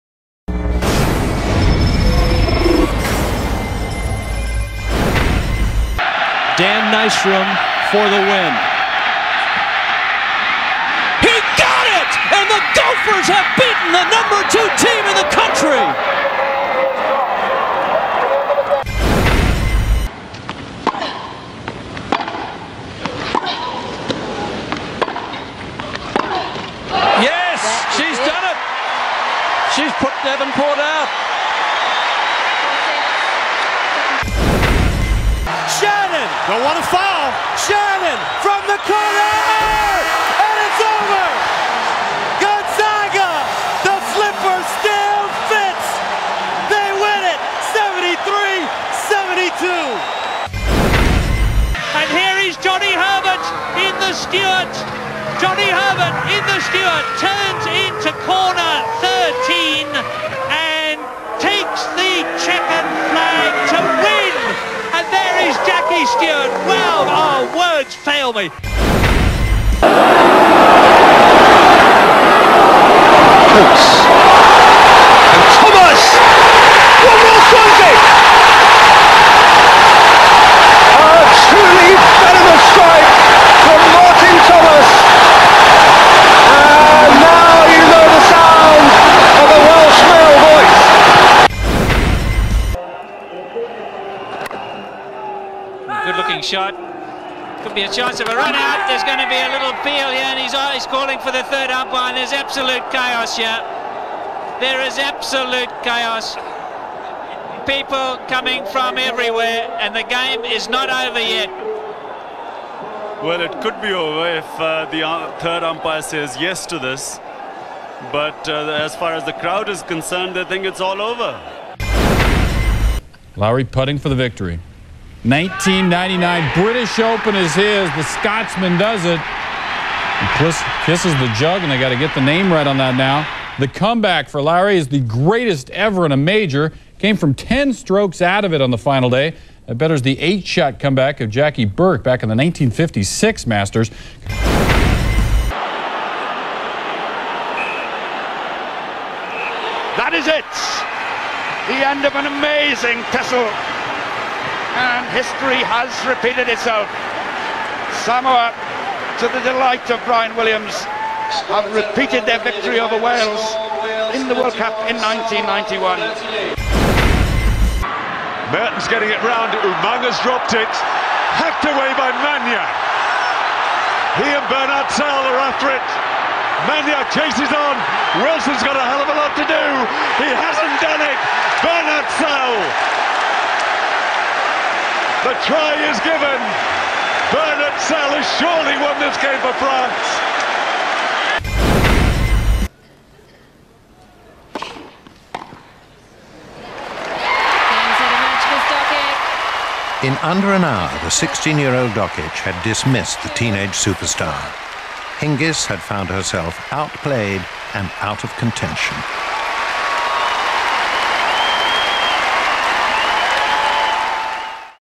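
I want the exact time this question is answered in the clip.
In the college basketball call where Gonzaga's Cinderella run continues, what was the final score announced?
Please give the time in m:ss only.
0:47.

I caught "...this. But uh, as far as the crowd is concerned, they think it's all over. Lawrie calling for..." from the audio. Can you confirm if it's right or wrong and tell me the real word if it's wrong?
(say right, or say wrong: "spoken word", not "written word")
wrong: "putting", not "calling".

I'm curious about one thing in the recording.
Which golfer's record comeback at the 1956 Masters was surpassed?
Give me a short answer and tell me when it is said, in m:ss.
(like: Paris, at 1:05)
Jackie Burke, at 2:21.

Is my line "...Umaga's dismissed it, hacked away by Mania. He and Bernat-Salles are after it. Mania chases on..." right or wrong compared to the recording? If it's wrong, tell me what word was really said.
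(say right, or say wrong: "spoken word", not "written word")
wrong: "dropped", not "dismissed".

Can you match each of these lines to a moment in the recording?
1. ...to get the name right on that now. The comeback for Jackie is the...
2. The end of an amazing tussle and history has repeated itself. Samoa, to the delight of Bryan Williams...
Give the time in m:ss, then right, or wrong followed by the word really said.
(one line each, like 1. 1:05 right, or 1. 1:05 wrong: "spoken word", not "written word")
1. 2:11 wrong: "Lawrie", not "Jackie"
2. 2:31 right.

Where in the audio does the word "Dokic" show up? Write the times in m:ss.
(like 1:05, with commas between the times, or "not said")
3:21.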